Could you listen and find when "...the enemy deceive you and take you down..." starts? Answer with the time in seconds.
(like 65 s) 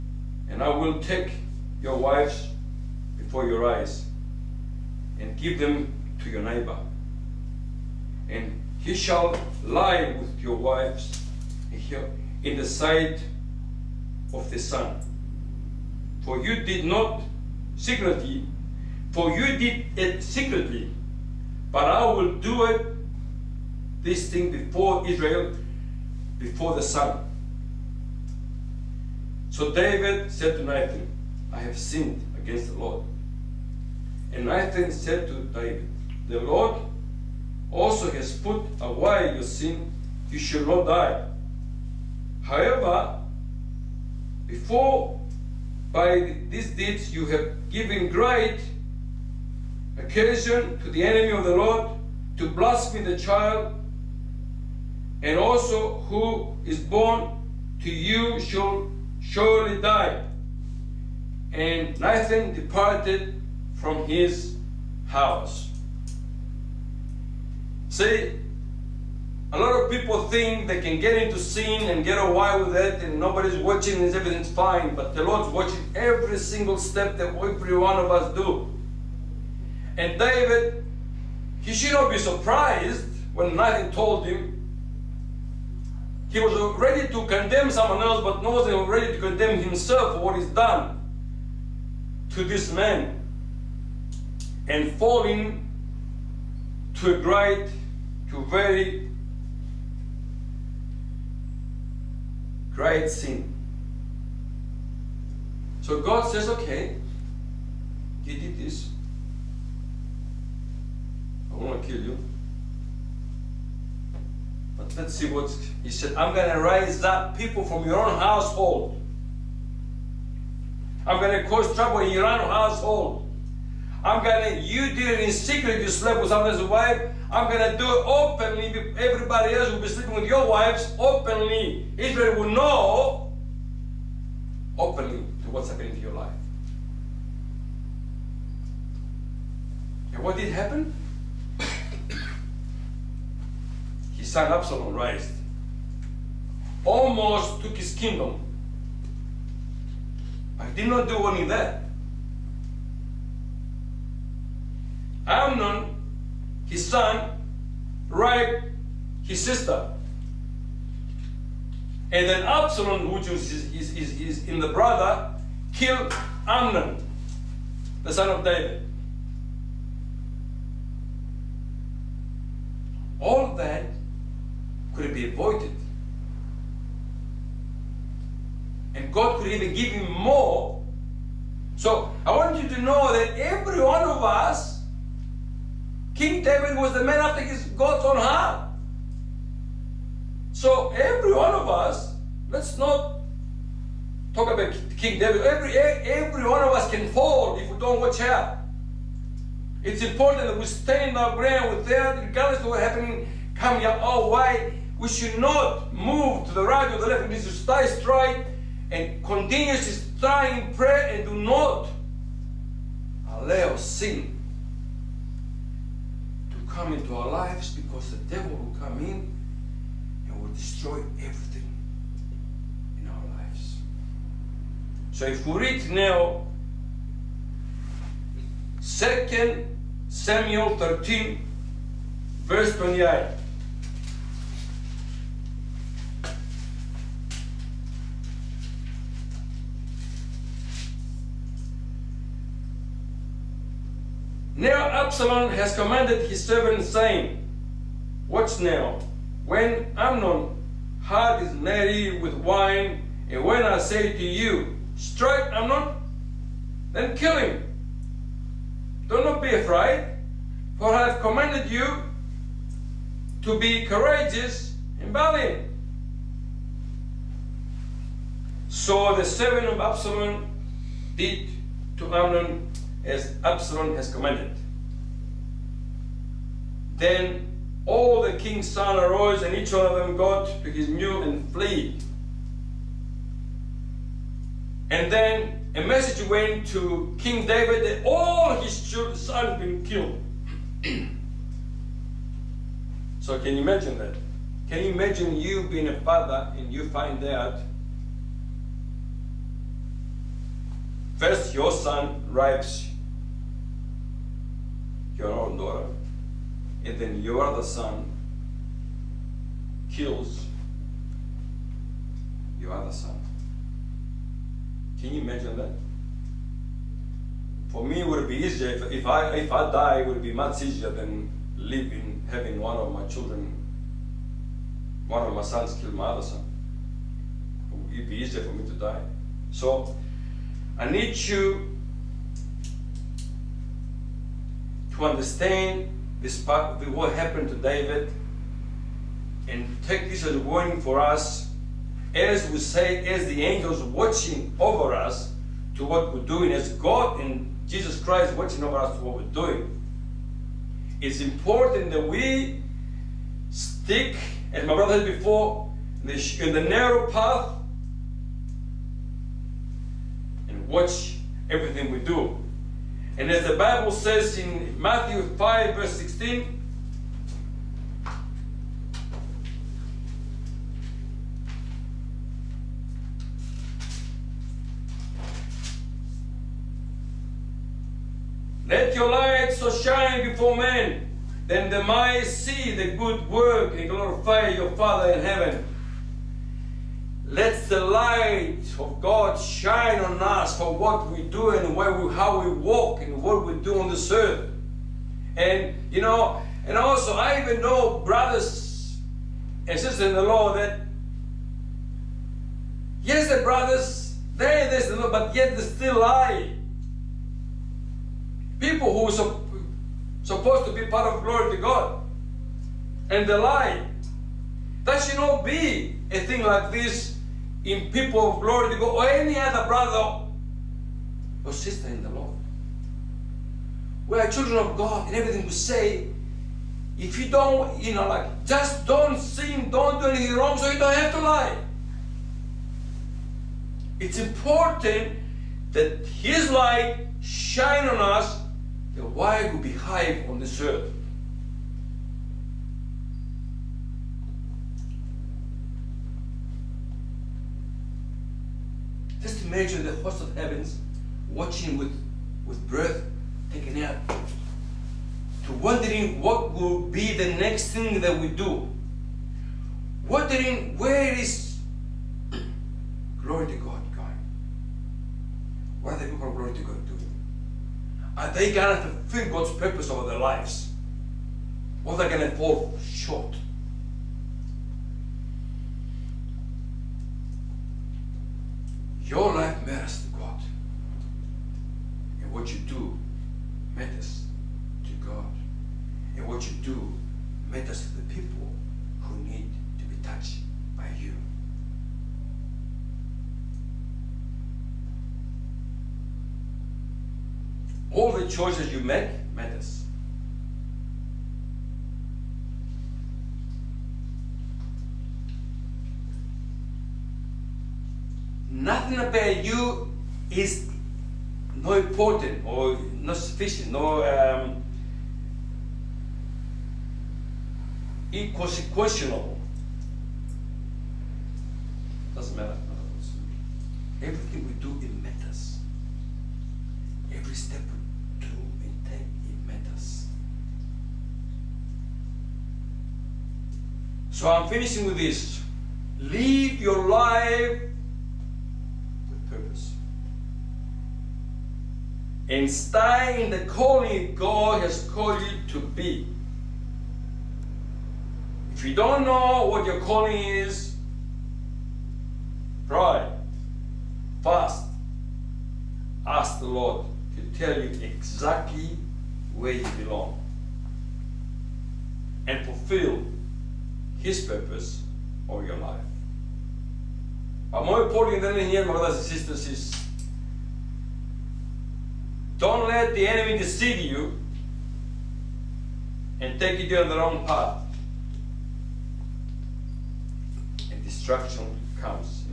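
572 s.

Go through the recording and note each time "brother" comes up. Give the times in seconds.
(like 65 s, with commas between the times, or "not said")
164 s, 354 s, 398 s, 403 s, 419 s, 568 s.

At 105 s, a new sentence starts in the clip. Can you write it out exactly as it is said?
So God says, okay, you did this.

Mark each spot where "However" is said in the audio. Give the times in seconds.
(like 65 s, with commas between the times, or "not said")
42 s.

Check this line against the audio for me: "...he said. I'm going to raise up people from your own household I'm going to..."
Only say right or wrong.
right.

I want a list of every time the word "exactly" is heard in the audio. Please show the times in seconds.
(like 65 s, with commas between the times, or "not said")
557 s.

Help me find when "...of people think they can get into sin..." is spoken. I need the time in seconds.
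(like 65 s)
69 s.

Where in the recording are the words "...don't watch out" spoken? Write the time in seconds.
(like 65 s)
197 s.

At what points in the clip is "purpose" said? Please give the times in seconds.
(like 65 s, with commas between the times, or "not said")
469 s, 539 s, 564 s.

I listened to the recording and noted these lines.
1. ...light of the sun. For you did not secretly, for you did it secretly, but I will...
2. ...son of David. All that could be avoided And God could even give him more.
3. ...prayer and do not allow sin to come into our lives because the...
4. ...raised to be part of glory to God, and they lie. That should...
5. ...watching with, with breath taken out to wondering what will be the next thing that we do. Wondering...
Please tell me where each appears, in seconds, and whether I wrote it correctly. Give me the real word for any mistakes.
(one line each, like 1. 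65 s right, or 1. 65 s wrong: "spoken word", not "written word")
1. 12 s wrong: "sight", not "light"
2. 168 s right
3. 210 s right
4. 410 s wrong: "supposed", not "raised"
5. 451 s right.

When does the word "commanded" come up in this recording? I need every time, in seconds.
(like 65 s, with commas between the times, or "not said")
245 s, 261 s, 274 s.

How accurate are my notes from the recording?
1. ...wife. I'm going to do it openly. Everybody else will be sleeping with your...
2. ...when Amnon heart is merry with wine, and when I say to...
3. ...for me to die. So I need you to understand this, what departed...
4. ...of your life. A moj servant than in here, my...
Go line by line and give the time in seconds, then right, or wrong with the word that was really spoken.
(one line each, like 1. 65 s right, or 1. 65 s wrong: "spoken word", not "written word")
1. 126 s right
2. 249 s right
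3. 328 s wrong: "happened", not "departed"
4. 565 s wrong: "important", not "servant".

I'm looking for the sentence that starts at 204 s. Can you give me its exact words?
We should not move to the right or the left.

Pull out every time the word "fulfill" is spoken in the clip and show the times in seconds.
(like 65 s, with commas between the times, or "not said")
468 s, 562 s.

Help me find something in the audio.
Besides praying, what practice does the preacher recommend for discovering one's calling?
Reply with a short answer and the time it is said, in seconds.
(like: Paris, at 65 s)
Fast, at 554 s.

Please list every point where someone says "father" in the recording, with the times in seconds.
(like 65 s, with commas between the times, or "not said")
296 s, 384 s.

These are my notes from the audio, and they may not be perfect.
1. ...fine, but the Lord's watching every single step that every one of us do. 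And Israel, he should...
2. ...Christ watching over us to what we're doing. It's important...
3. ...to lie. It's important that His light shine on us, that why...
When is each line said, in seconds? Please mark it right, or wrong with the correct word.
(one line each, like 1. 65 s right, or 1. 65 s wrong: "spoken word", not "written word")
1. 74 s wrong: "David", not "Israel"
2. 347 s right
3. 431 s right.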